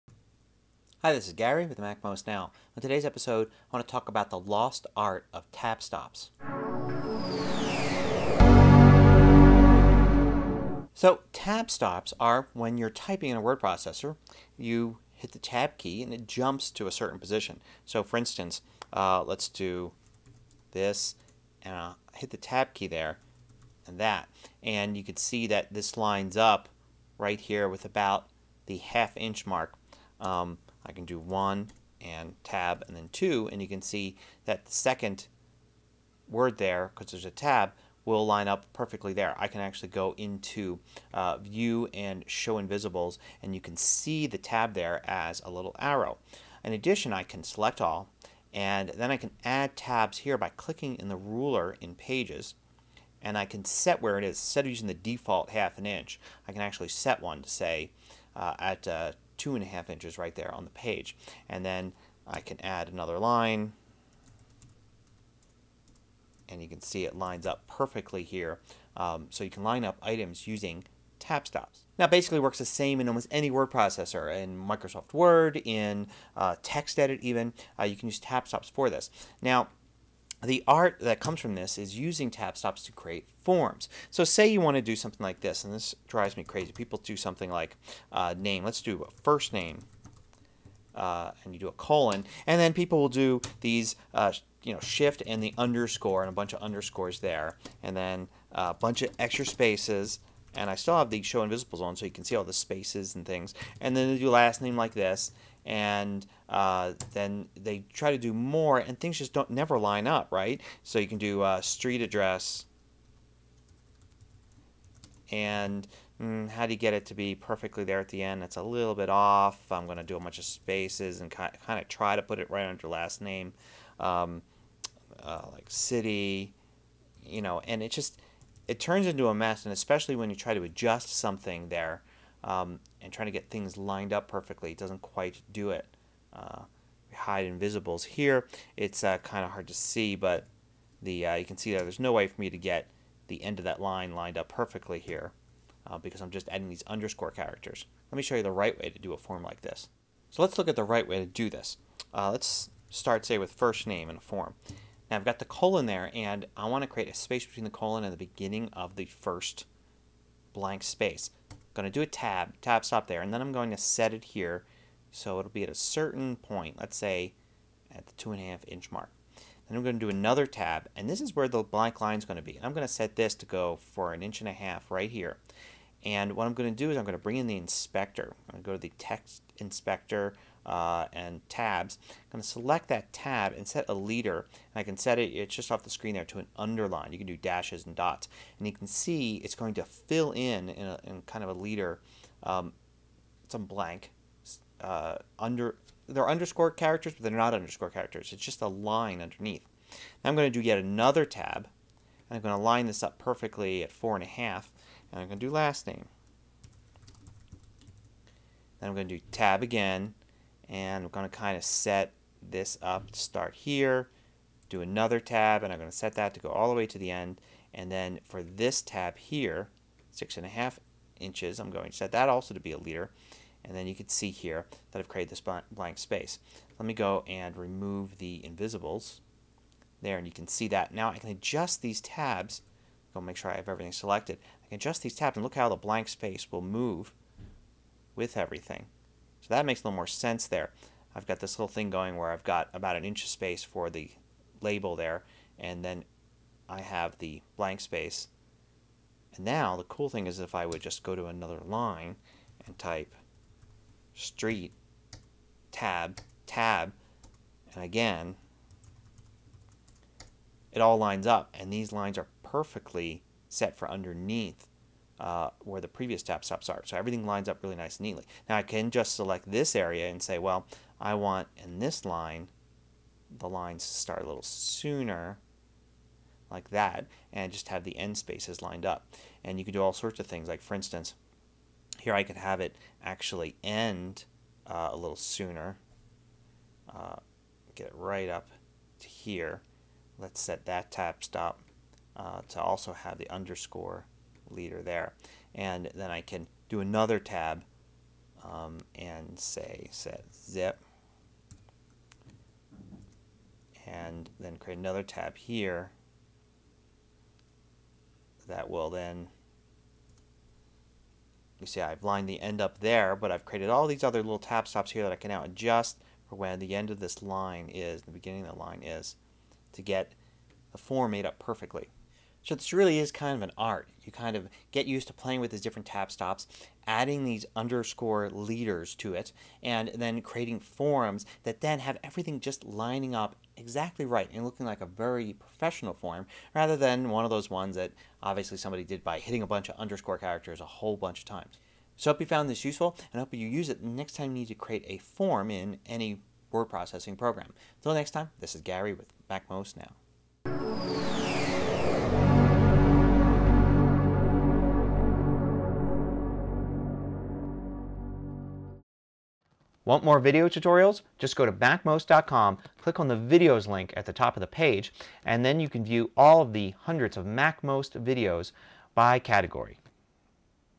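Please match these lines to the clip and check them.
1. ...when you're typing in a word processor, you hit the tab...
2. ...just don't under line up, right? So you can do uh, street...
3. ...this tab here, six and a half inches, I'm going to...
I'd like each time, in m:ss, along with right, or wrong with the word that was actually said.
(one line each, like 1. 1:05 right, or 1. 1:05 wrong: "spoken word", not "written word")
1. 0:12 right
2. 1:49 wrong: "never", not "under"
3. 3:38 right.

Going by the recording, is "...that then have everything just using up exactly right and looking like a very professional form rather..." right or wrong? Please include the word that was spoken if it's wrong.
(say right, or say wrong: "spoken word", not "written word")
wrong: "lining", not "using".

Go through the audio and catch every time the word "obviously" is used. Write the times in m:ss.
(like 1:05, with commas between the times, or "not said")
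5:38.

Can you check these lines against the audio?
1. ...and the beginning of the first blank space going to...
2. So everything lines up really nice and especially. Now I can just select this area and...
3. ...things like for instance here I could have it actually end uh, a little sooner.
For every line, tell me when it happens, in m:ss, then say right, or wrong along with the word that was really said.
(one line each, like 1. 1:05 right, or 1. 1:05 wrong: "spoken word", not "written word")
1. 2:38 right
2. 4:26 wrong: "neatly", not "especially"
3. 4:40 right.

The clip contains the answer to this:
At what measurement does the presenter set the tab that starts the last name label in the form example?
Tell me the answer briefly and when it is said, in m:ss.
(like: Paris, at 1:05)
four and a half, at 3:23.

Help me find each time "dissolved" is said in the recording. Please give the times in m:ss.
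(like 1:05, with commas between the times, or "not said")
not said.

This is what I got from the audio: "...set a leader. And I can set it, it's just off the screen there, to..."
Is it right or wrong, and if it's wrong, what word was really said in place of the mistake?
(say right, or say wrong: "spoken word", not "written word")
right.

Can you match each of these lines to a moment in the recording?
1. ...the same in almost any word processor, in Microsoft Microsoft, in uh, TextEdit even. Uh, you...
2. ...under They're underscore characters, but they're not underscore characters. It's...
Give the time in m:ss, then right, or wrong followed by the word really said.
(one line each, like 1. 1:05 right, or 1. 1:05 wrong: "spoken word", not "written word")
1. 1:12 wrong: "Word", not "Microsoft"
2. 3:15 right.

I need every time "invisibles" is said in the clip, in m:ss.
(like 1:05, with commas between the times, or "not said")
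0:42, 1:41, 2:17, 3:48.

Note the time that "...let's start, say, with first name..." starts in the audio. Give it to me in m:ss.
2:32.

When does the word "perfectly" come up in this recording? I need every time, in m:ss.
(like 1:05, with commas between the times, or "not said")
0:38, 1:07, 1:57, 2:14, 2:24, 3:23, 4:22, 5:21.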